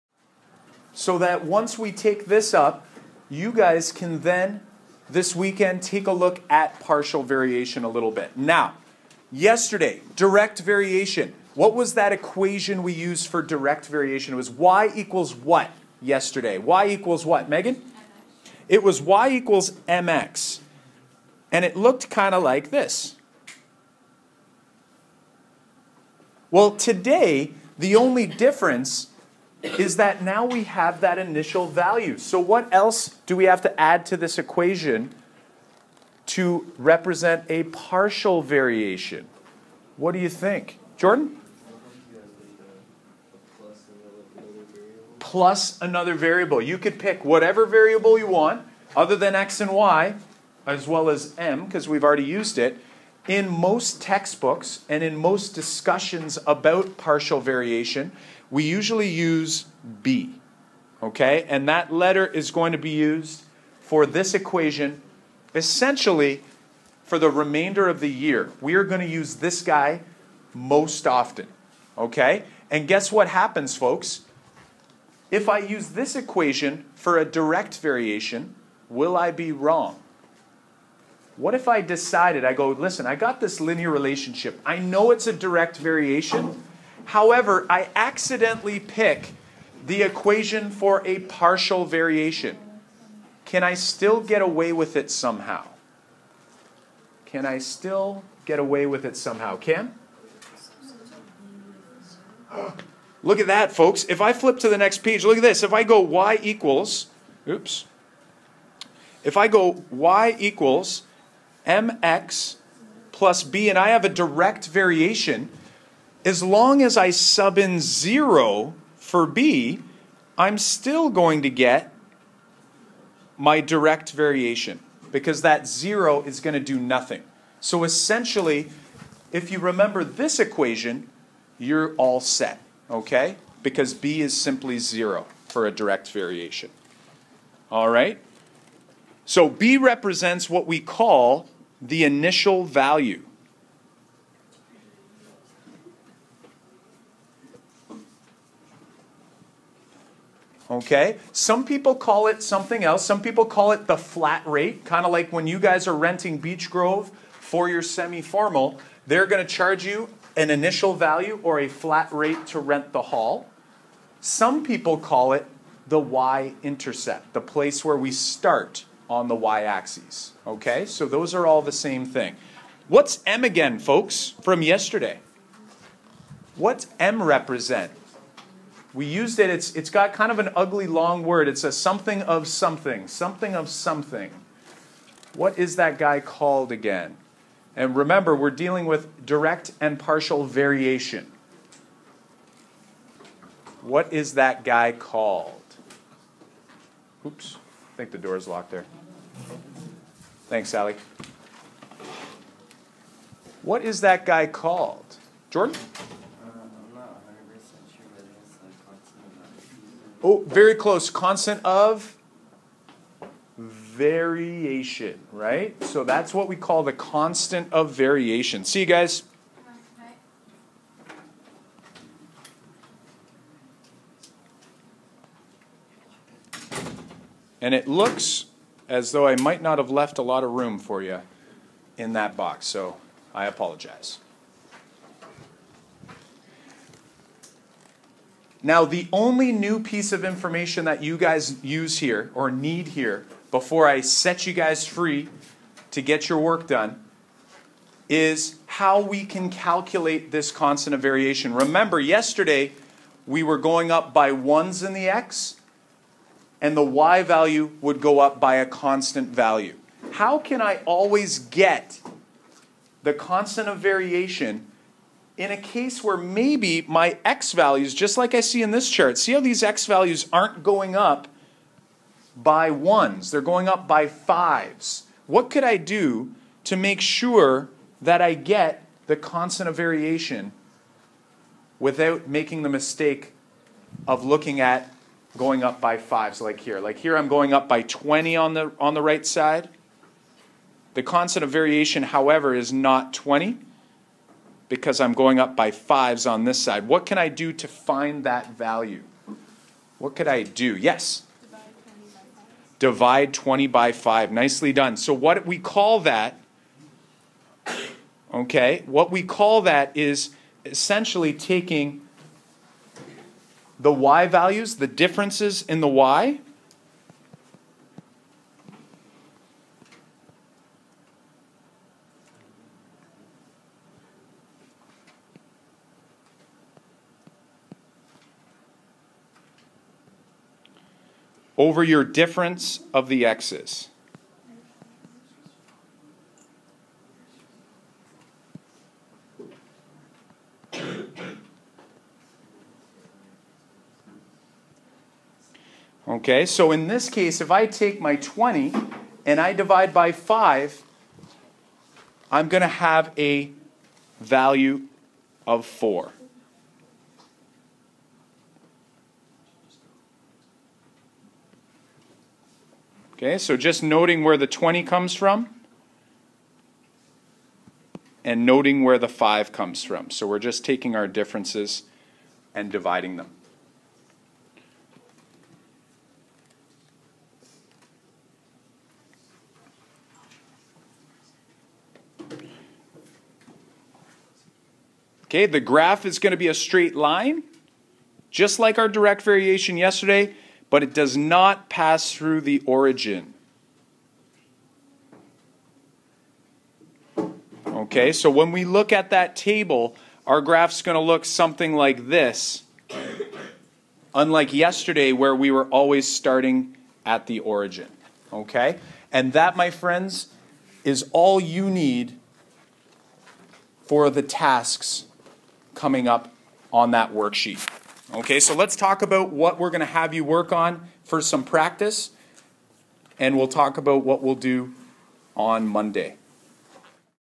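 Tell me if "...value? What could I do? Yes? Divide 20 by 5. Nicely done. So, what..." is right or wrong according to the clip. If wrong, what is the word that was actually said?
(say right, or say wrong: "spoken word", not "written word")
right.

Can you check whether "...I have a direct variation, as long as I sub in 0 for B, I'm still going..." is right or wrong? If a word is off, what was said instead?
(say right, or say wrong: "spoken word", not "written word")
right.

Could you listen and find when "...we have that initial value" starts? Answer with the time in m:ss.
0:30.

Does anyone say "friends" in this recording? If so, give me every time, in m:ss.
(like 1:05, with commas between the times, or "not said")
6:49.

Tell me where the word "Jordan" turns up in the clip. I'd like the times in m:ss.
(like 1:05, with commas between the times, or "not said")
0:40, 3:25.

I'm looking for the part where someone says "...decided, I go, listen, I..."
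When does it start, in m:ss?
1:21.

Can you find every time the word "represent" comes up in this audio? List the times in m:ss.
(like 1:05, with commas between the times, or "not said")
0:36, 2:19, 2:57.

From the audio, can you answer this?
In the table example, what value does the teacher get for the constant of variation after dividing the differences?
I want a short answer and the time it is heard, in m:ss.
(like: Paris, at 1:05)
4, at 5:55.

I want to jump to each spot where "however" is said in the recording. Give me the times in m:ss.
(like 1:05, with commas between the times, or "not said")
1:27, 4:52.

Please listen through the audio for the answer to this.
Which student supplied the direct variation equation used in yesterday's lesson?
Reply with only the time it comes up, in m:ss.
0:17.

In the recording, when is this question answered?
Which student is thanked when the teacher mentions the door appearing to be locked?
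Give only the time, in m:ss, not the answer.
3:20.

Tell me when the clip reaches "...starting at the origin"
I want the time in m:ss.
6:46.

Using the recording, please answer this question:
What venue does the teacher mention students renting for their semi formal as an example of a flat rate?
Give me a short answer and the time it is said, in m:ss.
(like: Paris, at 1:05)
Beach Grove, at 2:36.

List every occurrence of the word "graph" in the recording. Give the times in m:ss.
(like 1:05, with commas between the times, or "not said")
6:25, 6:40.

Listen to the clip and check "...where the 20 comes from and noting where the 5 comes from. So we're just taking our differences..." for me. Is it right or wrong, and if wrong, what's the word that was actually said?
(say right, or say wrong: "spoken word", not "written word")
right.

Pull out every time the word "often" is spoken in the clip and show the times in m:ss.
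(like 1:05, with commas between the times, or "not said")
1:11.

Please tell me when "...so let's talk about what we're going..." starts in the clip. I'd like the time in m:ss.
6:58.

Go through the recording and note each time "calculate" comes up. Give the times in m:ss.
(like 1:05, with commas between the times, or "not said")
4:09.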